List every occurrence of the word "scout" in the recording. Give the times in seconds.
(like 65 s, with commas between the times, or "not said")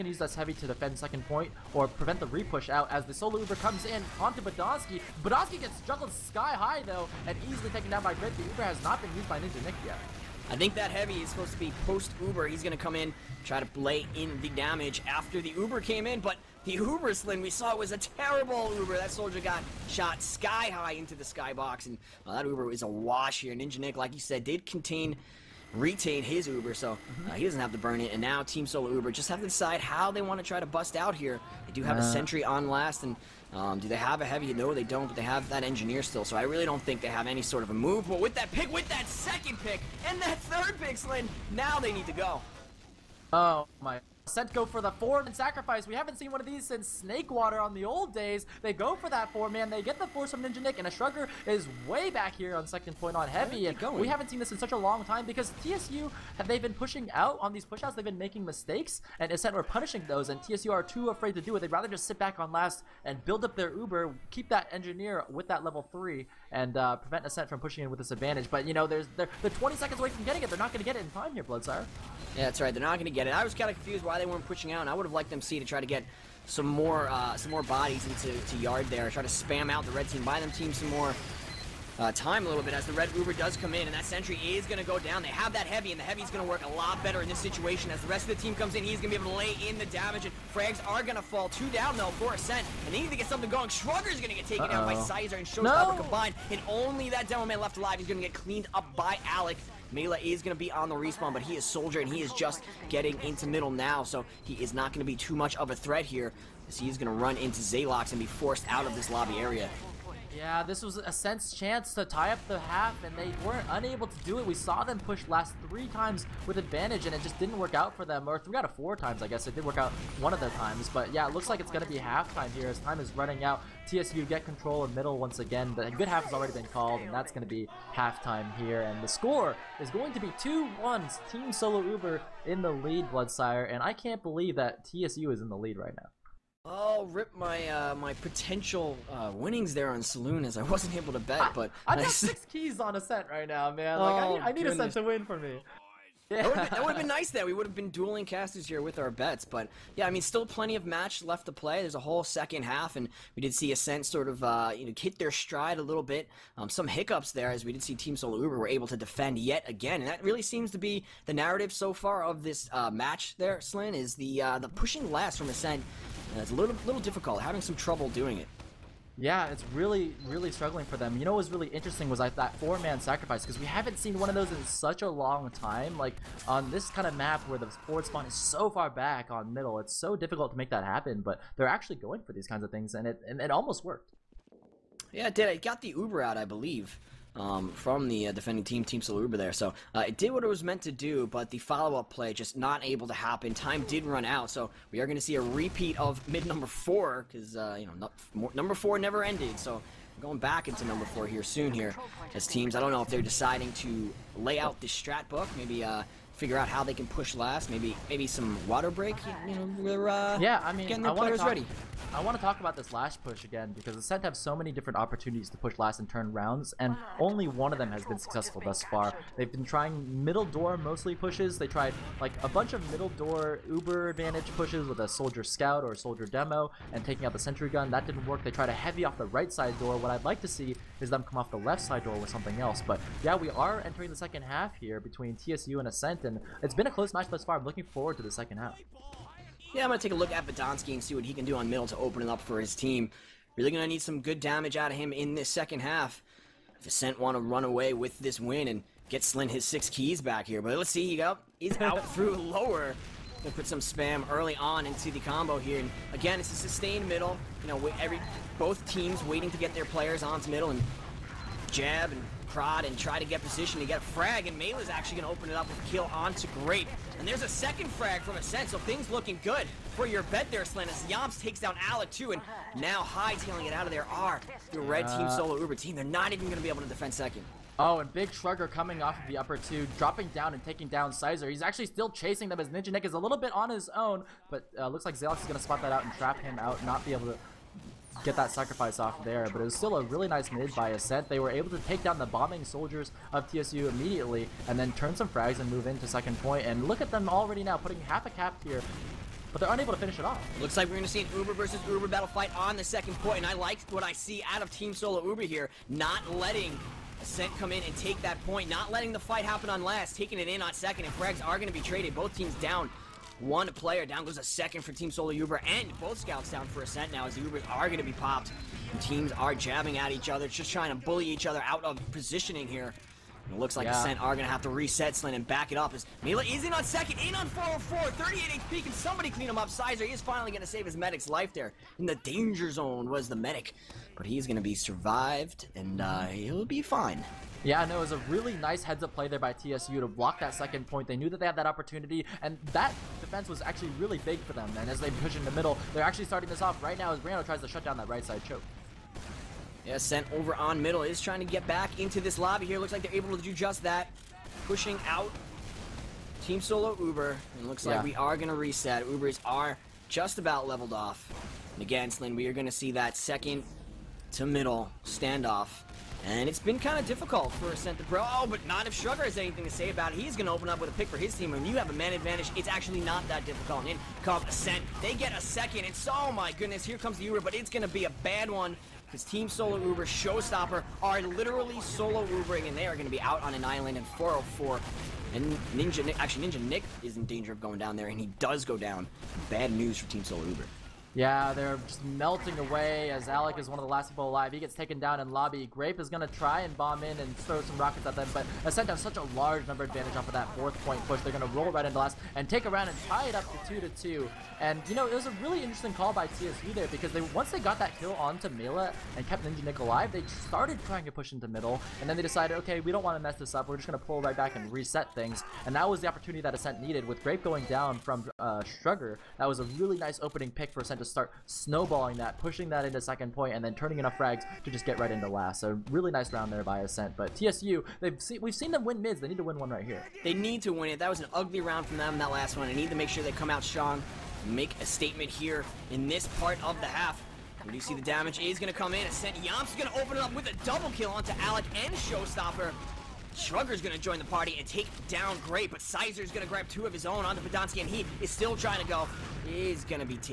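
225 s, 316 s.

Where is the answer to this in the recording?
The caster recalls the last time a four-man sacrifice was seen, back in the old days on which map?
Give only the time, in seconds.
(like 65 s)
47 s.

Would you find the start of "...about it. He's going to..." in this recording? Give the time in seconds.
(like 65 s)
369 s.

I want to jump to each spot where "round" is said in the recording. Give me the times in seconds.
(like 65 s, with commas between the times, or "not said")
216 s, 402 s, 426 s, 431 s.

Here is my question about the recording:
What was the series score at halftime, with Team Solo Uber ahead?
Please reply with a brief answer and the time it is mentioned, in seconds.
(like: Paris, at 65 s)
2-1, at 130 s.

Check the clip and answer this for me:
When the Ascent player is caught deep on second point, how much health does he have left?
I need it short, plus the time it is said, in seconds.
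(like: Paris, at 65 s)
38 HP, at 328 s.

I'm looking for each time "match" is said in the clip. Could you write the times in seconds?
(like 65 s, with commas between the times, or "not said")
150 s, 162 s, 237 s.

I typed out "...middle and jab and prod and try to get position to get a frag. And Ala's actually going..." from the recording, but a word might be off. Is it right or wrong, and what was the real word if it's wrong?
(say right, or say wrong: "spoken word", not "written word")
wrong: "Mela", not "Ala".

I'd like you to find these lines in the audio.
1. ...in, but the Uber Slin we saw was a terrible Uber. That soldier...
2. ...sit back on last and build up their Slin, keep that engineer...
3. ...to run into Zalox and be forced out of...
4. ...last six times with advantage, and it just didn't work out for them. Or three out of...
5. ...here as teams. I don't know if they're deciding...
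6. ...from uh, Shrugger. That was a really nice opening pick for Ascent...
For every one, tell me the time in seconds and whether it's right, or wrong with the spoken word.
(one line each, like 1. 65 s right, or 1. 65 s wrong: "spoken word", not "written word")
1. 16 s right
2. 62 s wrong: "Uber", not "Slin"
3. 107 s right
4. 115 s wrong: "three", not "six"
5. 201 s right
6. 417 s right.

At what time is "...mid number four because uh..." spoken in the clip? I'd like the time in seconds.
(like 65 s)
196 s.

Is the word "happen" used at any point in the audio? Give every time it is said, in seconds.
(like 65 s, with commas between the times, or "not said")
180 s, 193 s, 309 s.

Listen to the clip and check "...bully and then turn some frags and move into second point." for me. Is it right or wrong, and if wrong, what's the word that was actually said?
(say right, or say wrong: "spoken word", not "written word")
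wrong: "immediately", not "bully".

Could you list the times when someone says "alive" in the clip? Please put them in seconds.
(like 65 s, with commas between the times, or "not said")
97 s, 394 s, 409 s.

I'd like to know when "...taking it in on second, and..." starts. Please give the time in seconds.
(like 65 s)
310 s.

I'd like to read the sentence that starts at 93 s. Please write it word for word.
Shrugger's going to get taken uh -oh.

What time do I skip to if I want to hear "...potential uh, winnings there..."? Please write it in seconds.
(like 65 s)
138 s.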